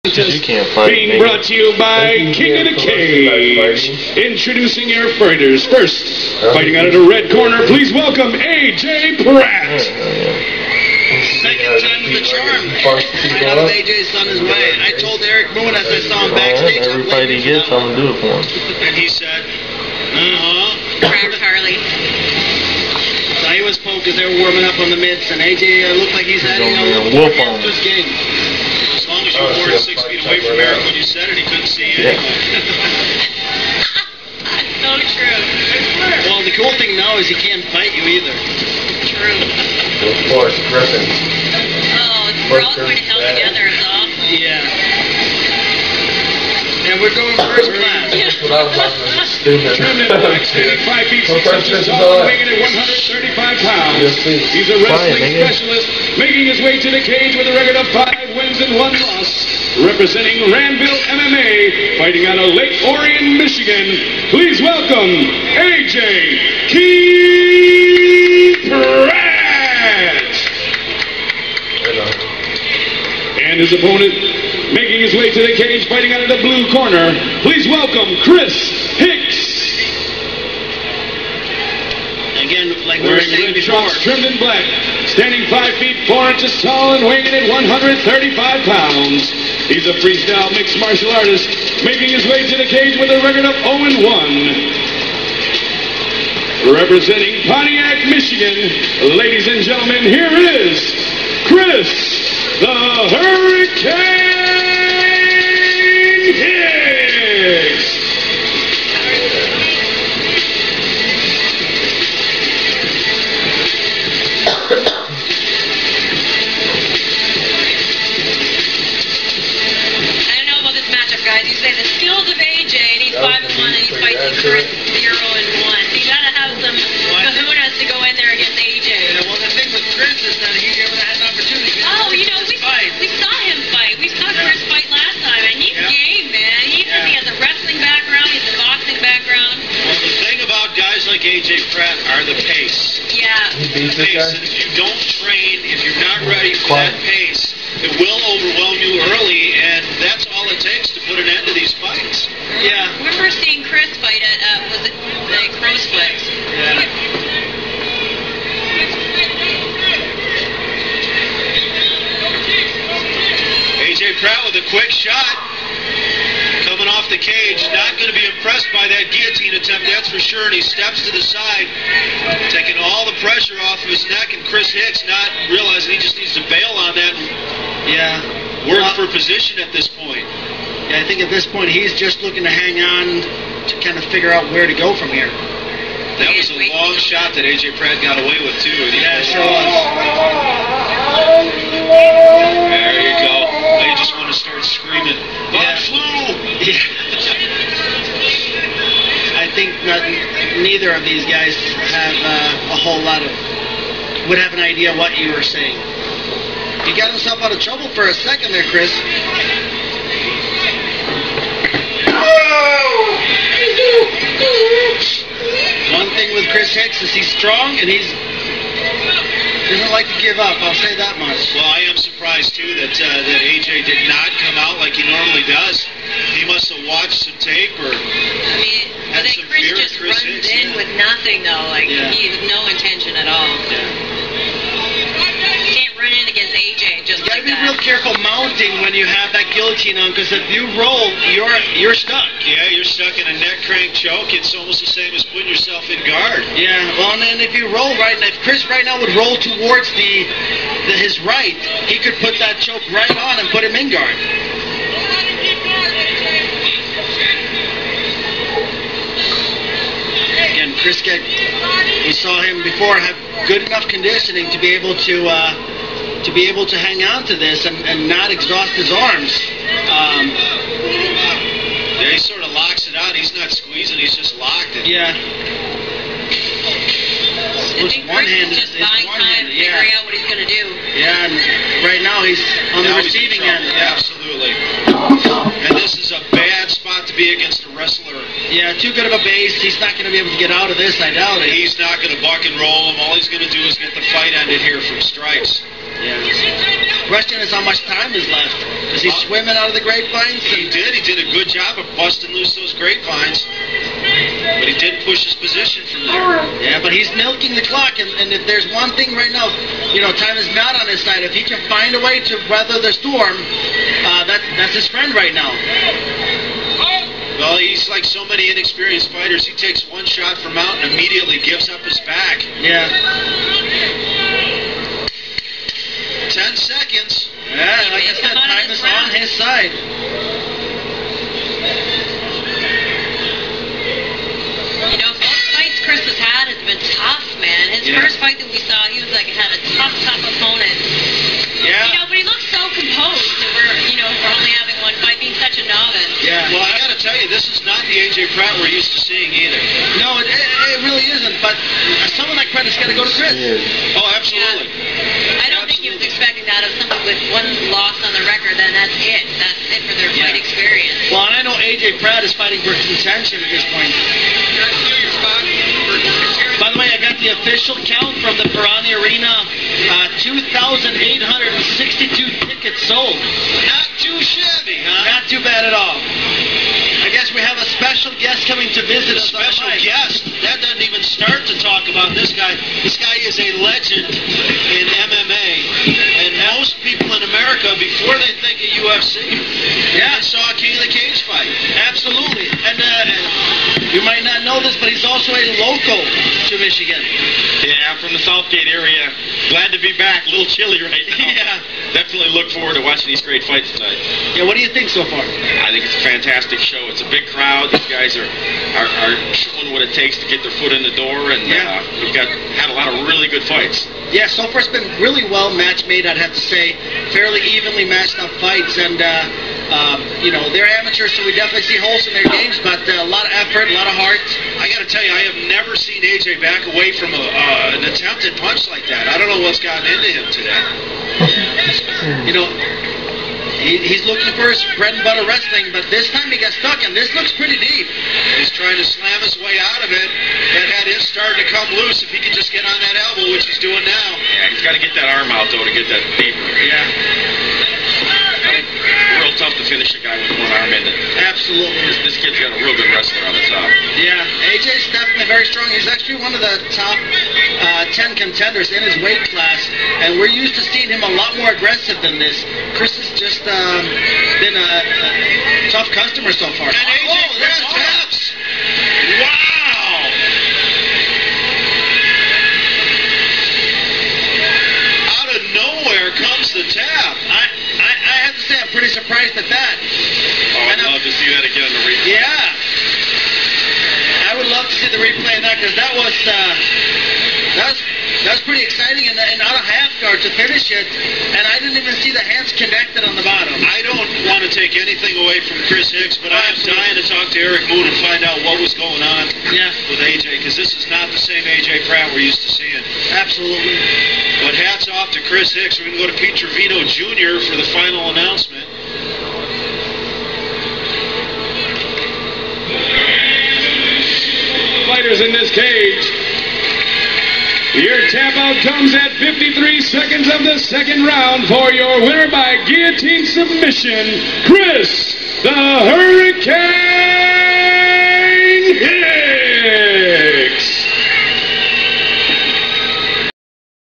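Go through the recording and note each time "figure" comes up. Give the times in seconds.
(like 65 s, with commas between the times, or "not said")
184 s, 279 s.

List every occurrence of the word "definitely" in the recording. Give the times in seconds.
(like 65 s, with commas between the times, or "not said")
401 s, 421 s, 454 s.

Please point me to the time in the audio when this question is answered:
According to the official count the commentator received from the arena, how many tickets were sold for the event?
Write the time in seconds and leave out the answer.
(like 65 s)
370 s.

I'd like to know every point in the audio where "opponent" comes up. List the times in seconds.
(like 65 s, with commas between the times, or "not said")
73 s, 340 s.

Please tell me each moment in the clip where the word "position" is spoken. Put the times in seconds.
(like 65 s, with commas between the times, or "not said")
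179 s, 305 s.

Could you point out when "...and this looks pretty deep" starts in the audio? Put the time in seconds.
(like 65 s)
436 s.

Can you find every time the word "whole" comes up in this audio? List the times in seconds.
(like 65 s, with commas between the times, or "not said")
202 s.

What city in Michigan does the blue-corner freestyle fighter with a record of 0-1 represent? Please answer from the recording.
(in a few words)
Pontiac.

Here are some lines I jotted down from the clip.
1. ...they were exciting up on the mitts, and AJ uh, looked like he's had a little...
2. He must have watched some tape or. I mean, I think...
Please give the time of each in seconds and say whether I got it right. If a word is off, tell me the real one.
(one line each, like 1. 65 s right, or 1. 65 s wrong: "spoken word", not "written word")
1. 24 s wrong: "warming", not "exciting"
2. 226 s right.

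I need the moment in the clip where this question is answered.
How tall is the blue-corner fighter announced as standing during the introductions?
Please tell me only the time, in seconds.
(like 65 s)
85 s.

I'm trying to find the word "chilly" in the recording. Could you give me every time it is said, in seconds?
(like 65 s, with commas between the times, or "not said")
400 s.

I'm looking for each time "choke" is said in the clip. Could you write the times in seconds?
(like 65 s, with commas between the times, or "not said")
243 s, 252 s.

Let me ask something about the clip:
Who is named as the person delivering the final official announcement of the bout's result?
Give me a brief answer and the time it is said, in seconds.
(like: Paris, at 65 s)
Pete Trevino Jr., at 506 s.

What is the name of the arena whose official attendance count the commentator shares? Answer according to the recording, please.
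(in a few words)
Perani Arena.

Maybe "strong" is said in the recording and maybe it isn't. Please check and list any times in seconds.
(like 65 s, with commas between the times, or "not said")
217 s, 455 s.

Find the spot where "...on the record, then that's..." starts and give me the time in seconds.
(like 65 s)
358 s.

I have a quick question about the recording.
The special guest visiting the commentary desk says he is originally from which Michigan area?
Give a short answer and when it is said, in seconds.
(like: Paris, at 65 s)
Southgate, at 398 s.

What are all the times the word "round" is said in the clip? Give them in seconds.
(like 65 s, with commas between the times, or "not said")
328 s, 521 s.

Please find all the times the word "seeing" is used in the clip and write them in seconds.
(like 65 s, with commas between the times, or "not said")
153 s, 348 s, 460 s, 502 s.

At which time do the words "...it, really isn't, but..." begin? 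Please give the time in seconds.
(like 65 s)
350 s.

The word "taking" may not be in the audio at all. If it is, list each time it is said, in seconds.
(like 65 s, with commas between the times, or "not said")
172 s.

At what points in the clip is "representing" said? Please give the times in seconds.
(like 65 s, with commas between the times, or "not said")
59 s, 96 s.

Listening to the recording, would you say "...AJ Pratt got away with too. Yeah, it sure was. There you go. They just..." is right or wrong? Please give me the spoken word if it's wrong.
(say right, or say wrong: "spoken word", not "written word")
right.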